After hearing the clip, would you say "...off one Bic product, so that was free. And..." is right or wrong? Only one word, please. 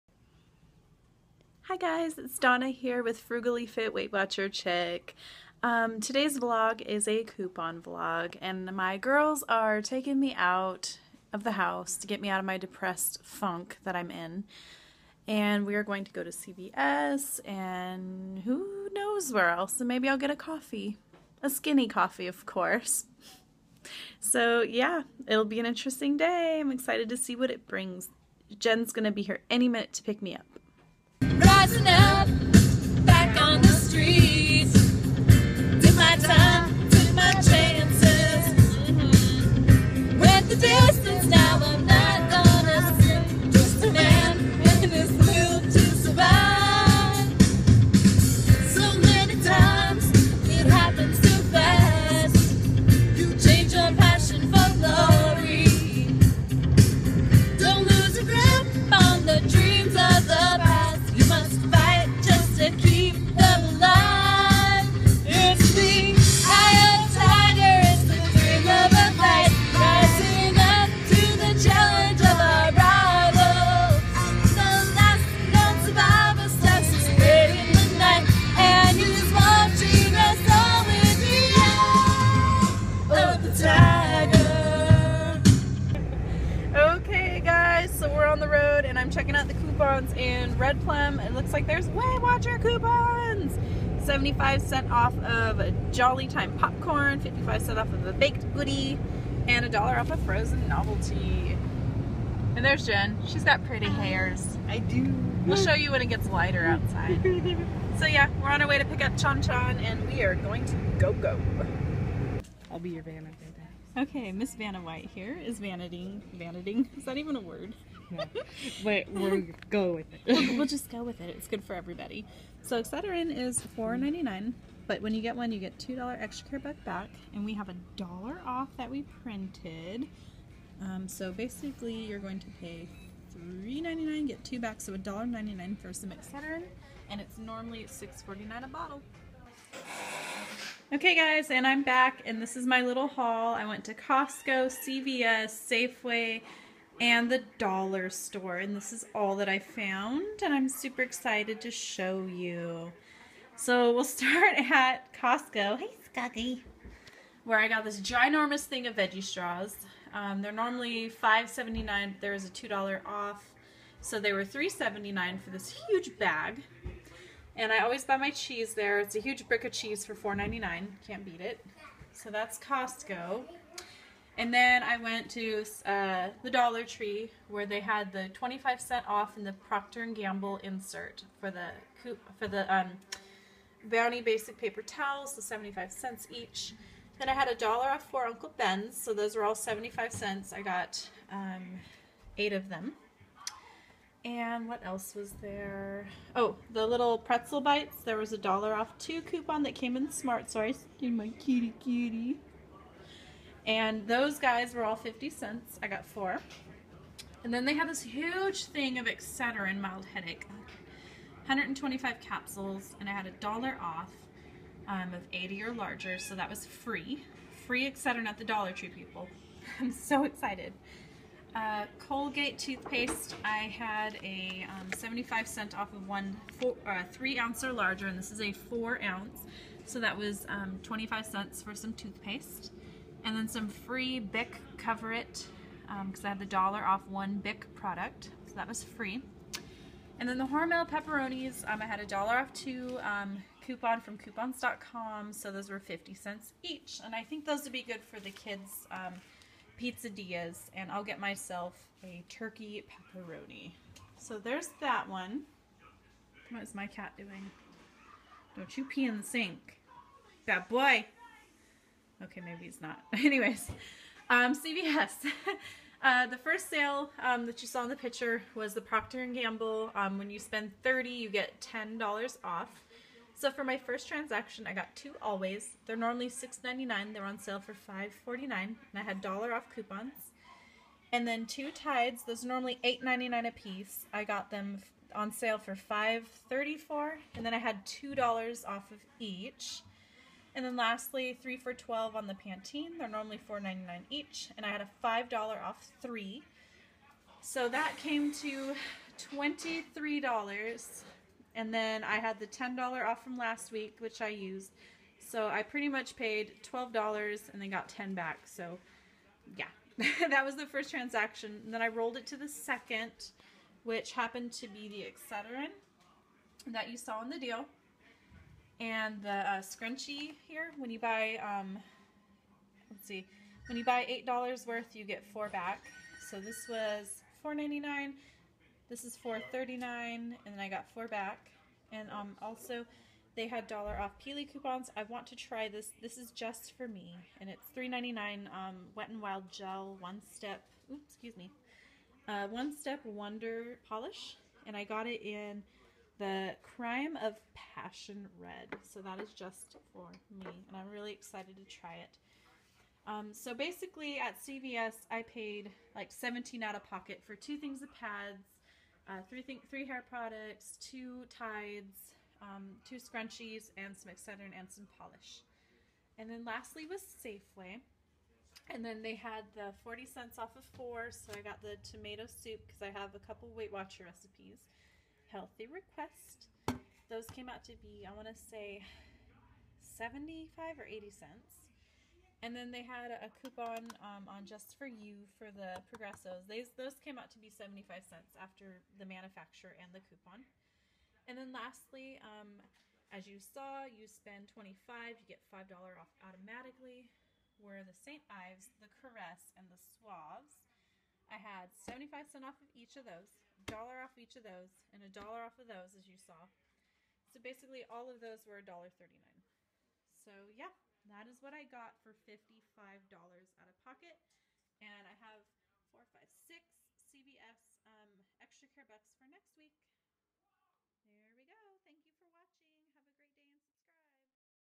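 right.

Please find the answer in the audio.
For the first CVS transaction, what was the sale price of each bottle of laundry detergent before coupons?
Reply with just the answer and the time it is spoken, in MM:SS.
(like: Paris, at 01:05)
$5.34, at 04:45.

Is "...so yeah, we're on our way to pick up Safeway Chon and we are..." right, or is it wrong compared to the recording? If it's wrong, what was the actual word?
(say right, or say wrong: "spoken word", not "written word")
wrong: "Chon", not "Safeway".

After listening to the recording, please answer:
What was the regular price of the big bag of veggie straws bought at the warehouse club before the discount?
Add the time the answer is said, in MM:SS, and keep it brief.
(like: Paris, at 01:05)
$5.79, at 02:41.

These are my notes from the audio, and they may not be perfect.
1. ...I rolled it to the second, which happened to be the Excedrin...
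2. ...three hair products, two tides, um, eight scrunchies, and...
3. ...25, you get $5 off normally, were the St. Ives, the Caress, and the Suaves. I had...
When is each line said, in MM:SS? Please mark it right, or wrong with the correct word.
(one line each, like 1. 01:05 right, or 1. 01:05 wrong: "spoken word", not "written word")
1. 05:11 right
2. 05:59 wrong: "two", not "eight"
3. 06:34 wrong: "automatically", not "normally".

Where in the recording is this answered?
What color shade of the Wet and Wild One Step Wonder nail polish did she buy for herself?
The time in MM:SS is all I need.
05:46.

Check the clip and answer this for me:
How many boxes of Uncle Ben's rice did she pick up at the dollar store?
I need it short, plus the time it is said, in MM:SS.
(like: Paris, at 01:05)
8, at 03:12.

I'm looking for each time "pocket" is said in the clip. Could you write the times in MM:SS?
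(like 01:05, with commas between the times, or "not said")
05:56, 06:53.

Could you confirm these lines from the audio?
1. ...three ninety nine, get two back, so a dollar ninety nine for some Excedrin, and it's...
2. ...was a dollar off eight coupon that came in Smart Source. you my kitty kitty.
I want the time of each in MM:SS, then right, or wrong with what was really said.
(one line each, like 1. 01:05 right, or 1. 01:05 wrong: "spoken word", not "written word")
1. 02:13 right
2. 03:18 wrong: "two", not "eight".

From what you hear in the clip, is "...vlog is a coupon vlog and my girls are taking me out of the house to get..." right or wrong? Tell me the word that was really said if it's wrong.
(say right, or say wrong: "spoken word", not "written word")
right.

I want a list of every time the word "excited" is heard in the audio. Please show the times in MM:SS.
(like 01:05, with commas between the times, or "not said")
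00:26, 02:31, 03:40, 05:51.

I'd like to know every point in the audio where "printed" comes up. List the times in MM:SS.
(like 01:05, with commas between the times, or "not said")
02:09.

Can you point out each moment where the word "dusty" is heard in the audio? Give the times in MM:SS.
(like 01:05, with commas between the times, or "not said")
not said.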